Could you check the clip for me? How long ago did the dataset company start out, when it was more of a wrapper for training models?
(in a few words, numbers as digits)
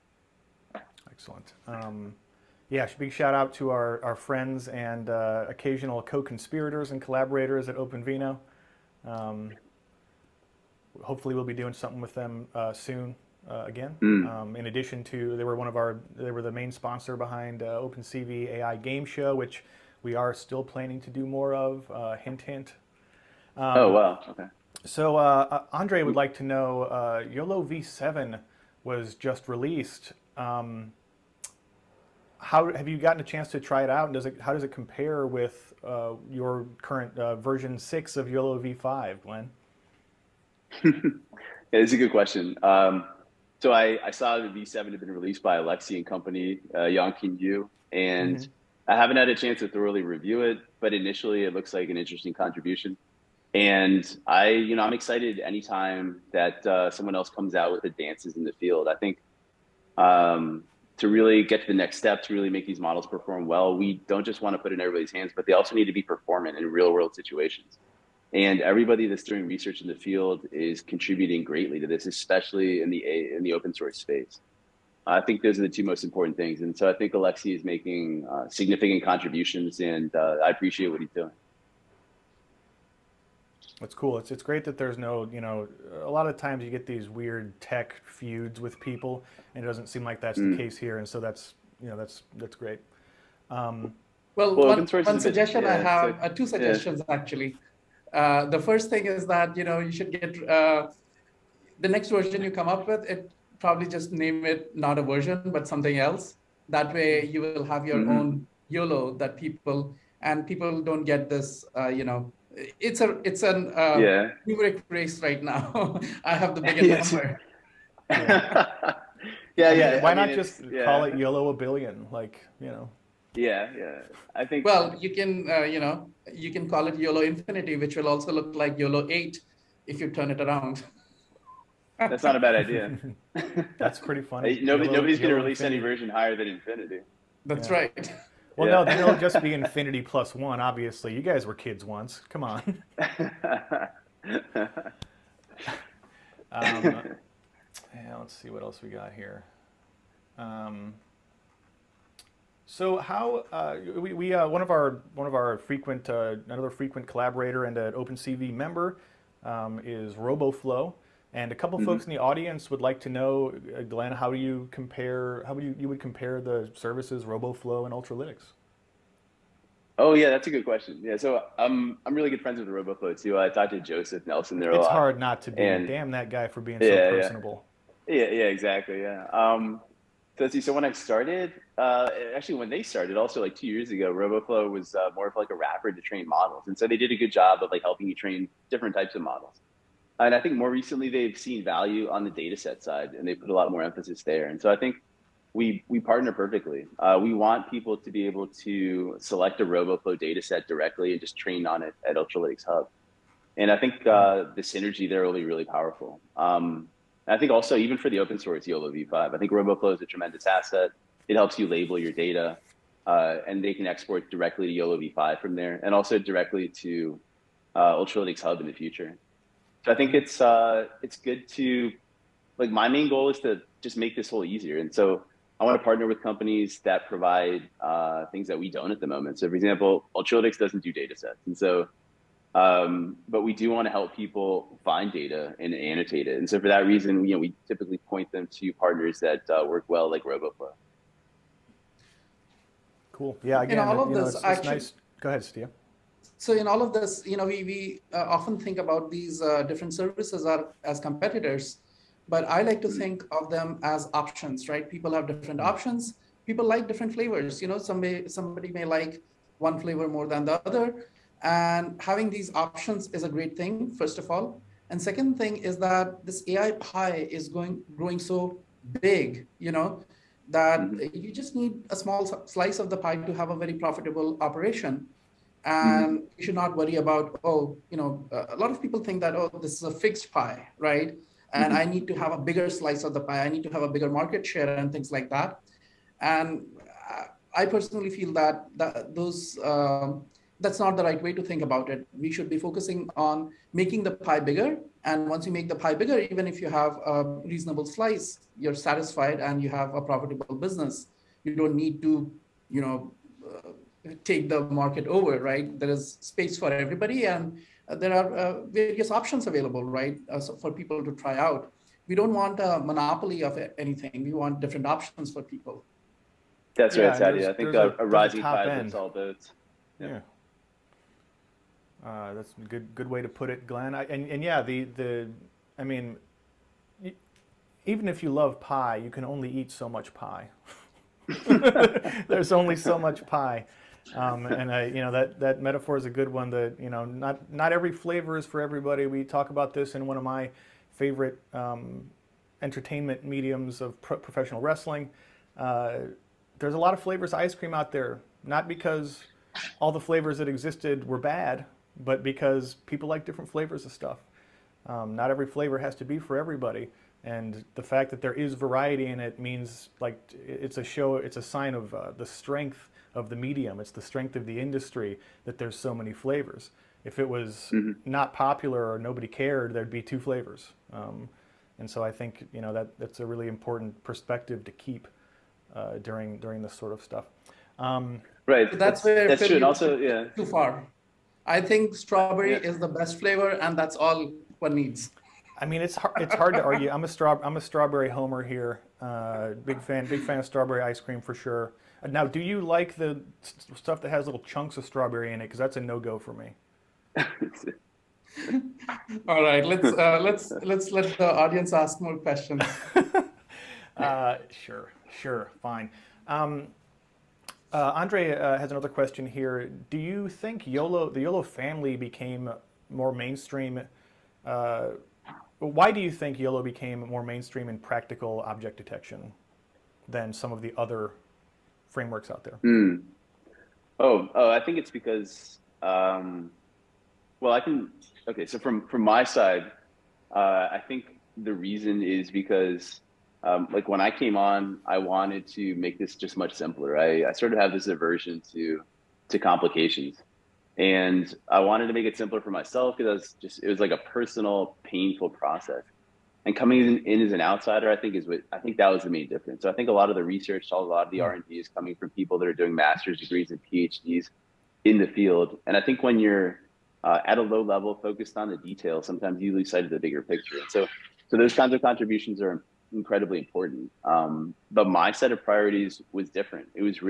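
2 years ago.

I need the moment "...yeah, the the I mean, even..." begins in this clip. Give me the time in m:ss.
5:24.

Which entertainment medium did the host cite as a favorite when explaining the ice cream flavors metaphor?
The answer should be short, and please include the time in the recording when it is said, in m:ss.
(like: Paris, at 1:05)
professional wrestling, at 5:44.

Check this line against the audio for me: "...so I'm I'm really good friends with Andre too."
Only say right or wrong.
wrong.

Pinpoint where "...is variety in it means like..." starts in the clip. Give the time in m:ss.
5:58.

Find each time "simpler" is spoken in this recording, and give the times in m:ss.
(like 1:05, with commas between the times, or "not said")
7:16, 7:22.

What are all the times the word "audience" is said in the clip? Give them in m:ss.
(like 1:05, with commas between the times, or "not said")
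2:42, 6:41.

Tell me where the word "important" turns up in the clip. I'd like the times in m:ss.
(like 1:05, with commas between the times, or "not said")
1:16, 6:13, 7:43.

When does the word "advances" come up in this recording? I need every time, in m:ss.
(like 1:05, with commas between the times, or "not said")
0:57.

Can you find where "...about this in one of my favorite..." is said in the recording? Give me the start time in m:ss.
5:39.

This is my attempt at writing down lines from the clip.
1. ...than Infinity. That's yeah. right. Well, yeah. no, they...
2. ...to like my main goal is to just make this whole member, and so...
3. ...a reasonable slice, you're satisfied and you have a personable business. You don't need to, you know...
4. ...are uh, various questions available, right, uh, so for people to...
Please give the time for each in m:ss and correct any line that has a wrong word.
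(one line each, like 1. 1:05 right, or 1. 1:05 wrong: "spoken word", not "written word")
1. 2:16 right
2. 3:41 wrong: "easier", not "member"
3. 4:57 wrong: "profitable", not "personable"
4. 5:08 wrong: "options", not "questions".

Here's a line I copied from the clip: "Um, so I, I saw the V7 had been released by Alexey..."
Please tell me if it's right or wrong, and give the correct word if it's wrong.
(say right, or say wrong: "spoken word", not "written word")
right.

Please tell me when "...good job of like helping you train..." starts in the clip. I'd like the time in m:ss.
3:07.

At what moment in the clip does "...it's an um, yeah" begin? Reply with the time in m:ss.
1:53.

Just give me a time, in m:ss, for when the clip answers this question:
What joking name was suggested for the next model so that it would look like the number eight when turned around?
2:06.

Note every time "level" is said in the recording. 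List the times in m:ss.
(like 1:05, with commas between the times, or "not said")
7:37.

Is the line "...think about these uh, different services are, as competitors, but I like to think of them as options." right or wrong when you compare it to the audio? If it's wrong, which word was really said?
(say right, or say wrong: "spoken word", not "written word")
right.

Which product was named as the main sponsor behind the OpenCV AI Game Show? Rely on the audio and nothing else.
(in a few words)
OpenVINO.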